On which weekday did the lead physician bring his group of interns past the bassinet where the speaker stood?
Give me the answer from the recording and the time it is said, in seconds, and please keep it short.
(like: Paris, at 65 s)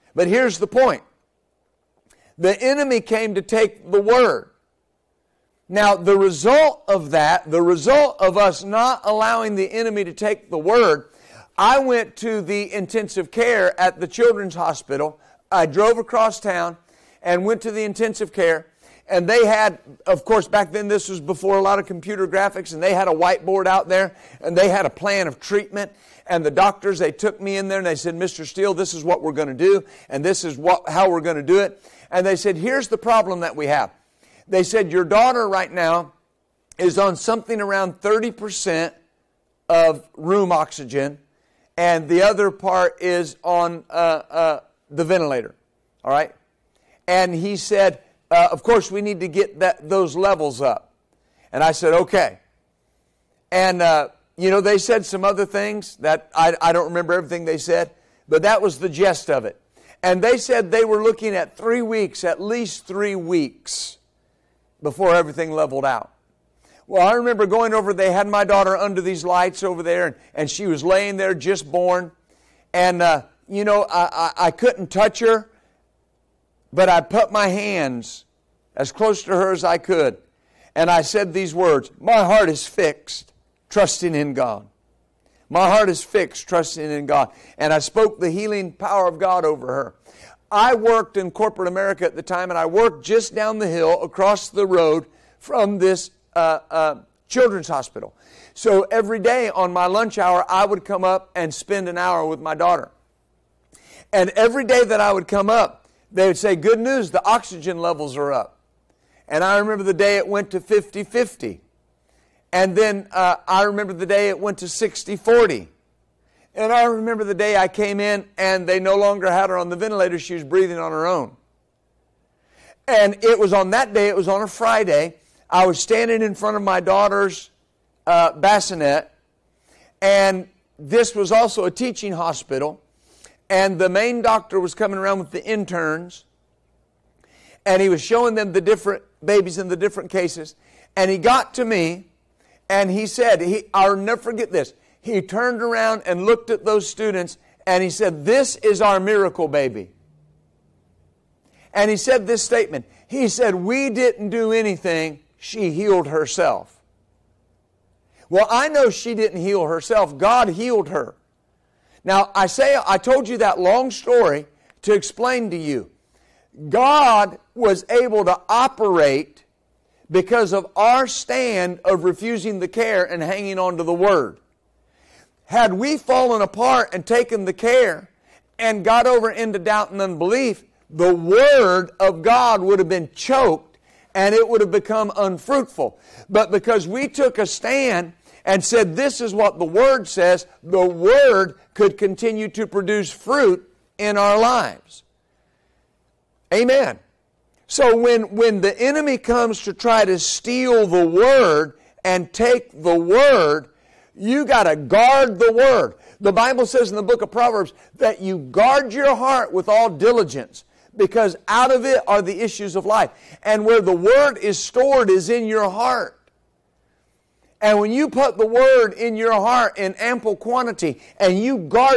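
Friday, at 124 s.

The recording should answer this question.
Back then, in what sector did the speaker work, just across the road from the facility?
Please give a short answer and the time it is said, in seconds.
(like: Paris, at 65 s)
corporate America, at 91 s.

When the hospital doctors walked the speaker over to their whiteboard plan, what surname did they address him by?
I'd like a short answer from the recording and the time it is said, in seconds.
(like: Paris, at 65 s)
Steele, at 28 s.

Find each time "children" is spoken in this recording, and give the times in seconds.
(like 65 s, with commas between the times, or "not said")
14 s, 97 s.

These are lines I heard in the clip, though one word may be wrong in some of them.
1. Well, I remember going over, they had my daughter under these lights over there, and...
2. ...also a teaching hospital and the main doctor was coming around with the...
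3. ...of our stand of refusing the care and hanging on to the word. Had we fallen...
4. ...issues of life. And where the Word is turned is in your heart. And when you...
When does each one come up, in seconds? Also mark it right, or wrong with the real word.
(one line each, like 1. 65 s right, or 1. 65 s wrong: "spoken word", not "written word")
1. 66 s right
2. 131 s right
3. 170 s right
4. 212 s wrong: "stored", not "turned".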